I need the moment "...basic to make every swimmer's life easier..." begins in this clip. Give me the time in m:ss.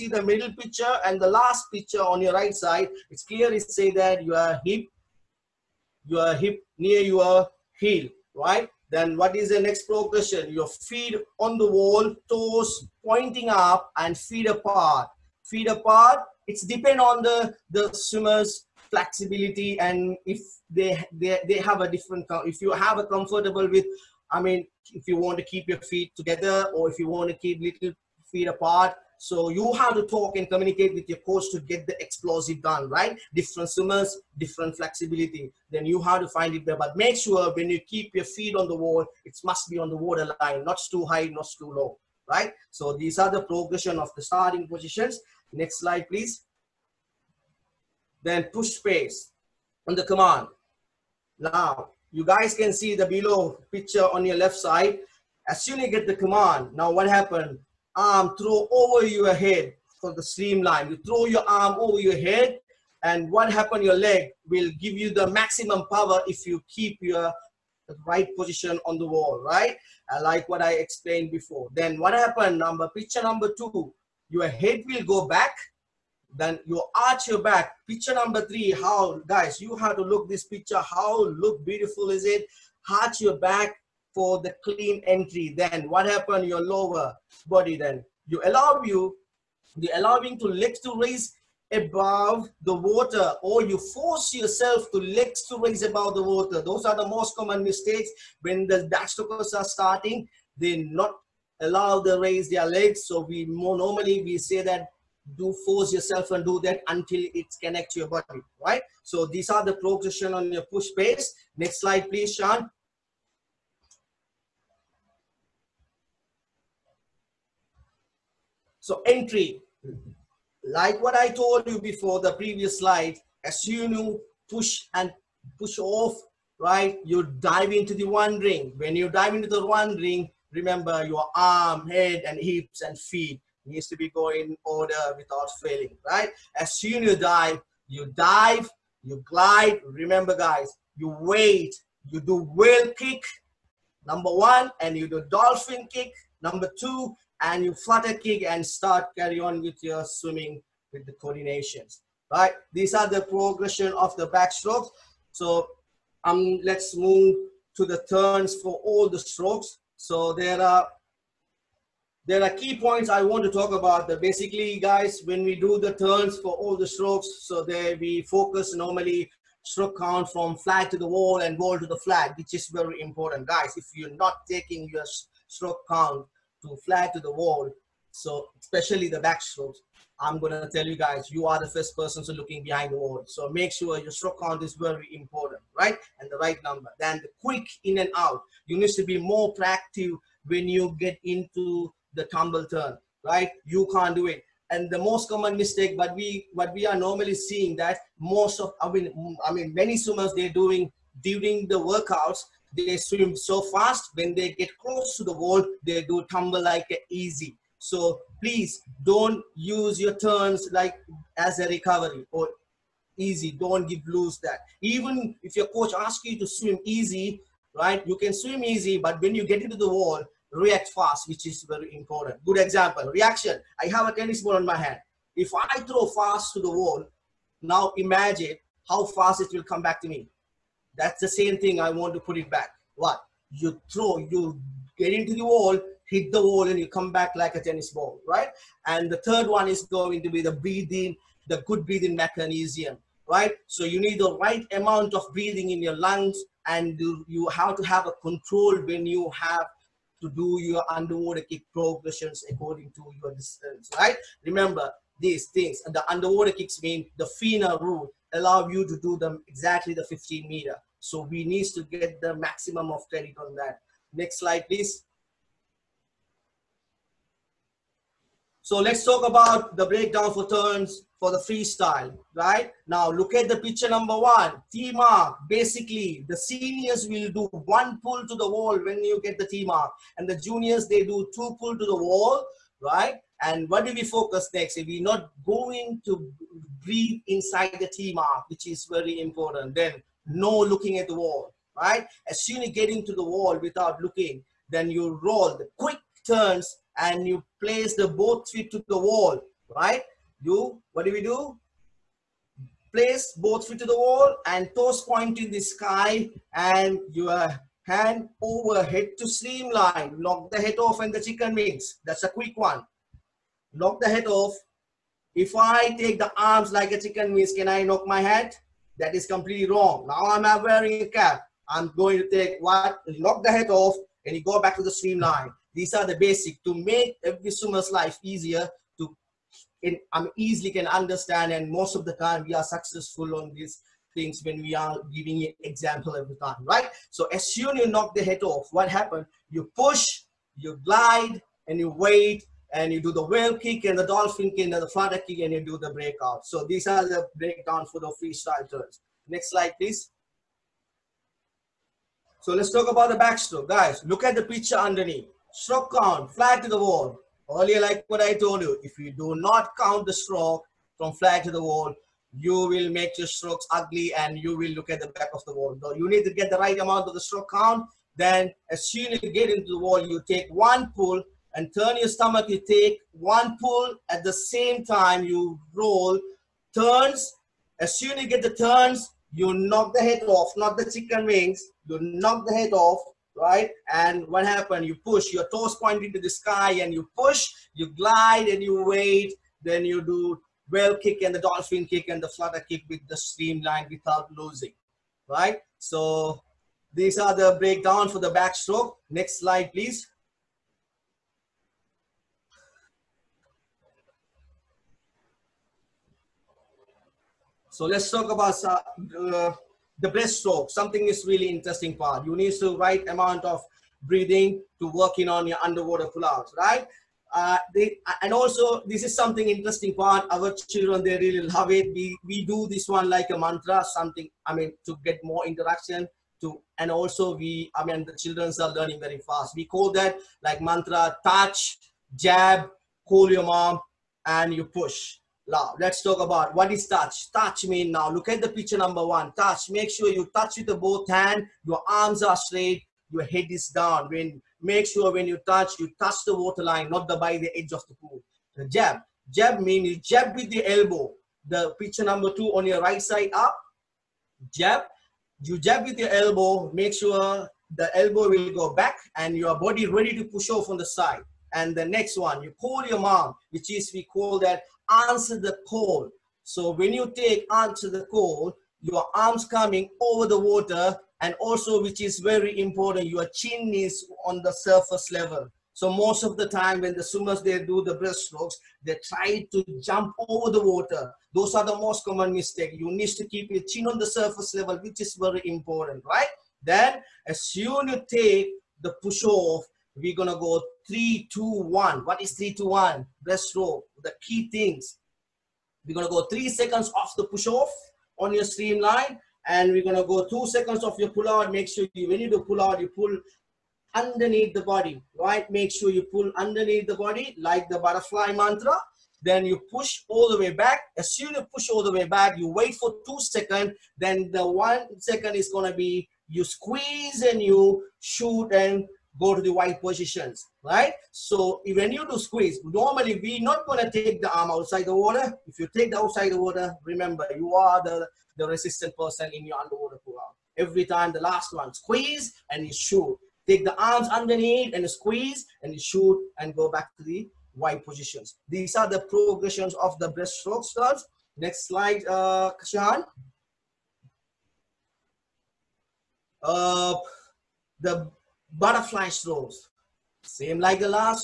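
5:26.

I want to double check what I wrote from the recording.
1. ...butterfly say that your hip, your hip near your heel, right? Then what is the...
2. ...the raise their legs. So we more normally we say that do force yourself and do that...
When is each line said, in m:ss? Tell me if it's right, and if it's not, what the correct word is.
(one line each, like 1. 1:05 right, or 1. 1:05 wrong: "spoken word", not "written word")
1. 0:03 wrong: "clearly", not "butterfly"
2. 1:42 right.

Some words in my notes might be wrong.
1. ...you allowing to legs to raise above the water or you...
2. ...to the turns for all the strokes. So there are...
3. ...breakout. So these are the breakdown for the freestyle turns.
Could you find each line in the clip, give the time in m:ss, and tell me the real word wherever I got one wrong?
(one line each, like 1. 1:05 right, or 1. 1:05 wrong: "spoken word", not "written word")
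1. 1:29 right
2. 2:37 right
3. 5:45 right.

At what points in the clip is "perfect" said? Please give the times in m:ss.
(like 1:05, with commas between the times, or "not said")
not said.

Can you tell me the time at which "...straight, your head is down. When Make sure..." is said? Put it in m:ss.
7:22.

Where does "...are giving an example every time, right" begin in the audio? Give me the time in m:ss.
5:34.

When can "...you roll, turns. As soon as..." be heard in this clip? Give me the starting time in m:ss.
6:15.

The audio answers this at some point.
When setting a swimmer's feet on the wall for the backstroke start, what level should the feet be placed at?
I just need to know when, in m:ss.
0:39.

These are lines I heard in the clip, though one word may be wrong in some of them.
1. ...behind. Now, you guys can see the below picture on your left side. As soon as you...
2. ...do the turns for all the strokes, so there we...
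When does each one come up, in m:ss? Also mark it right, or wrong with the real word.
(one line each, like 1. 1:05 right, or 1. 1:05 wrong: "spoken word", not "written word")
1. 0:50 wrong: "command", not "behind"
2. 2:45 right.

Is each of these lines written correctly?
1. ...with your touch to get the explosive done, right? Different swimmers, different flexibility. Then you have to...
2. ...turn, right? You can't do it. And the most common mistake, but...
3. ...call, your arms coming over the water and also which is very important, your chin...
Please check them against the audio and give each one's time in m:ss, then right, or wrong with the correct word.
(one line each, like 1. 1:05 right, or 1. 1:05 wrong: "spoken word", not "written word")
1. 0:30 wrong: "coach", not "touch"
2. 3:12 right
3. 7:48 right.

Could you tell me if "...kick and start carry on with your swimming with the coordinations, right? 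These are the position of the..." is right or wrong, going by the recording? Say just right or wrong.
wrong.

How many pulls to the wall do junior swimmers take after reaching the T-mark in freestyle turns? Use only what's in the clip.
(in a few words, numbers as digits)
2.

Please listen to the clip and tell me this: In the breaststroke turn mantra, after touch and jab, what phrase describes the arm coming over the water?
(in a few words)
call your mom.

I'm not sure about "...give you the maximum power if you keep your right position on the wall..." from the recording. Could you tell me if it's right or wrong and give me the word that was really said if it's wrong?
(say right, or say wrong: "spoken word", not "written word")
right.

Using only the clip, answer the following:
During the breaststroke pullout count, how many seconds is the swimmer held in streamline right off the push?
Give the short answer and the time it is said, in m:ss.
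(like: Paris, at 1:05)
3 seconds, at 8:16.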